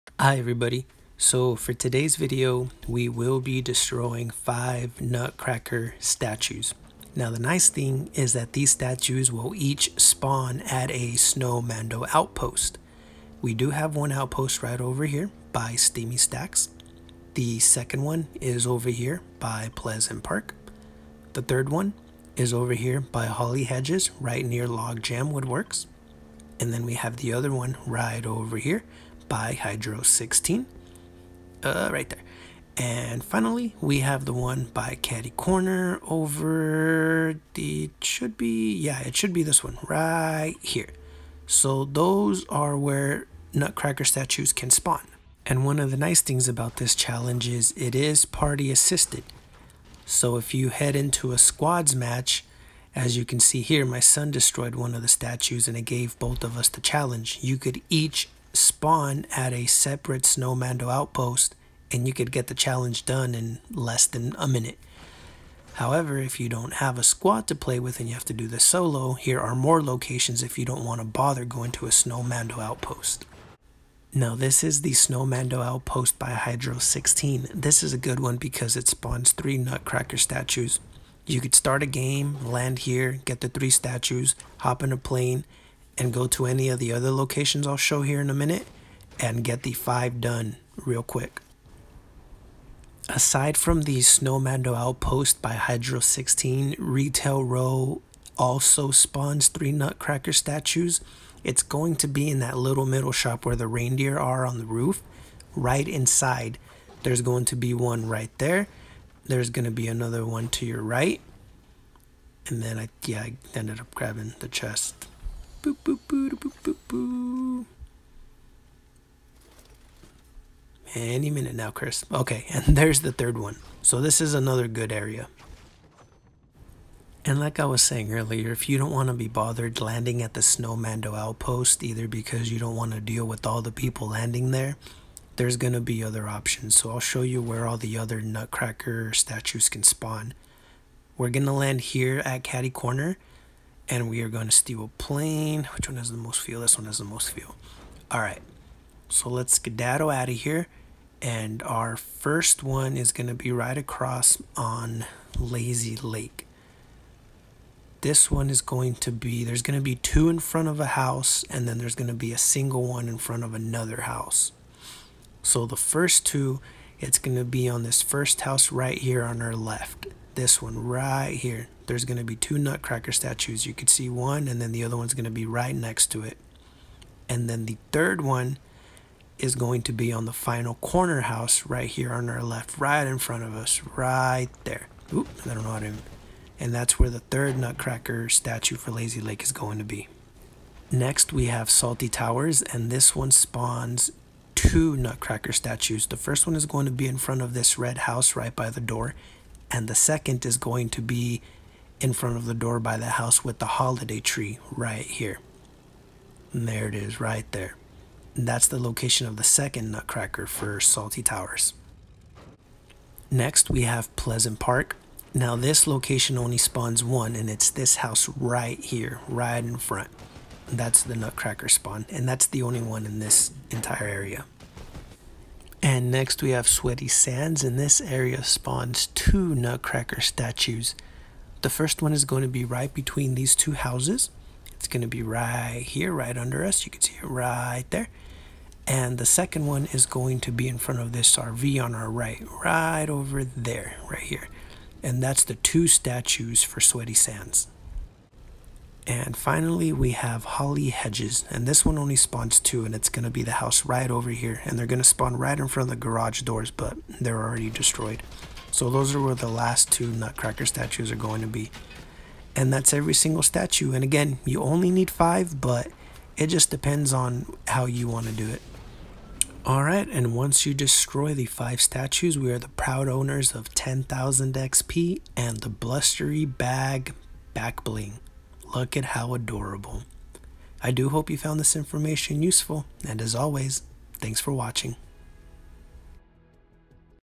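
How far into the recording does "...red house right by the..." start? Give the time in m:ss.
3:17.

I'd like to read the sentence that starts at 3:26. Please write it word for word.
And there it is right there.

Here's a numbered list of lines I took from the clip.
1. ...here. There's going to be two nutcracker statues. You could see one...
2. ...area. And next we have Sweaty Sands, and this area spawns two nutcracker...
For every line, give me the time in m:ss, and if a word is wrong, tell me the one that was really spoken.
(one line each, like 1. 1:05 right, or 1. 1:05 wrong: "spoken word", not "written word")
1. 2:51 right
2. 3:44 right.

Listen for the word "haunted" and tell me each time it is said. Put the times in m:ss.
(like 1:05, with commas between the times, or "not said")
not said.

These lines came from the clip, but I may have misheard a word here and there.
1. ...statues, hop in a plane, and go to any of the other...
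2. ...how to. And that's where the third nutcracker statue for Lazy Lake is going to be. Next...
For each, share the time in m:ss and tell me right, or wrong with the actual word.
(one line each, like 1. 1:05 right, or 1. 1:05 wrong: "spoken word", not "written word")
1. 1:23 right
2. 3:05 right.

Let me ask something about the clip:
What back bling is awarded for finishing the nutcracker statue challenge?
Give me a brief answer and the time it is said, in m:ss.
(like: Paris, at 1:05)
Blustery Bag, at 4:35.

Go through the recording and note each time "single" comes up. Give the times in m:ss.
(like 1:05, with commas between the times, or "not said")
2:42, 4:23.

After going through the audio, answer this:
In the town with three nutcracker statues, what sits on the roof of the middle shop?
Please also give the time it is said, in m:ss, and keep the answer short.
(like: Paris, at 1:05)
reindeer, at 1:43.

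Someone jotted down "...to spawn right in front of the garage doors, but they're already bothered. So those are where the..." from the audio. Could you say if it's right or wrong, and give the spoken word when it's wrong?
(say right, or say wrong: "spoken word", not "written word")
wrong: "destroyed", not "bothered".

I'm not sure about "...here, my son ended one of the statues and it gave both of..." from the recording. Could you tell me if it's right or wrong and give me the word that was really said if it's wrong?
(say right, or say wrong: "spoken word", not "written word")
wrong: "destroyed", not "ended".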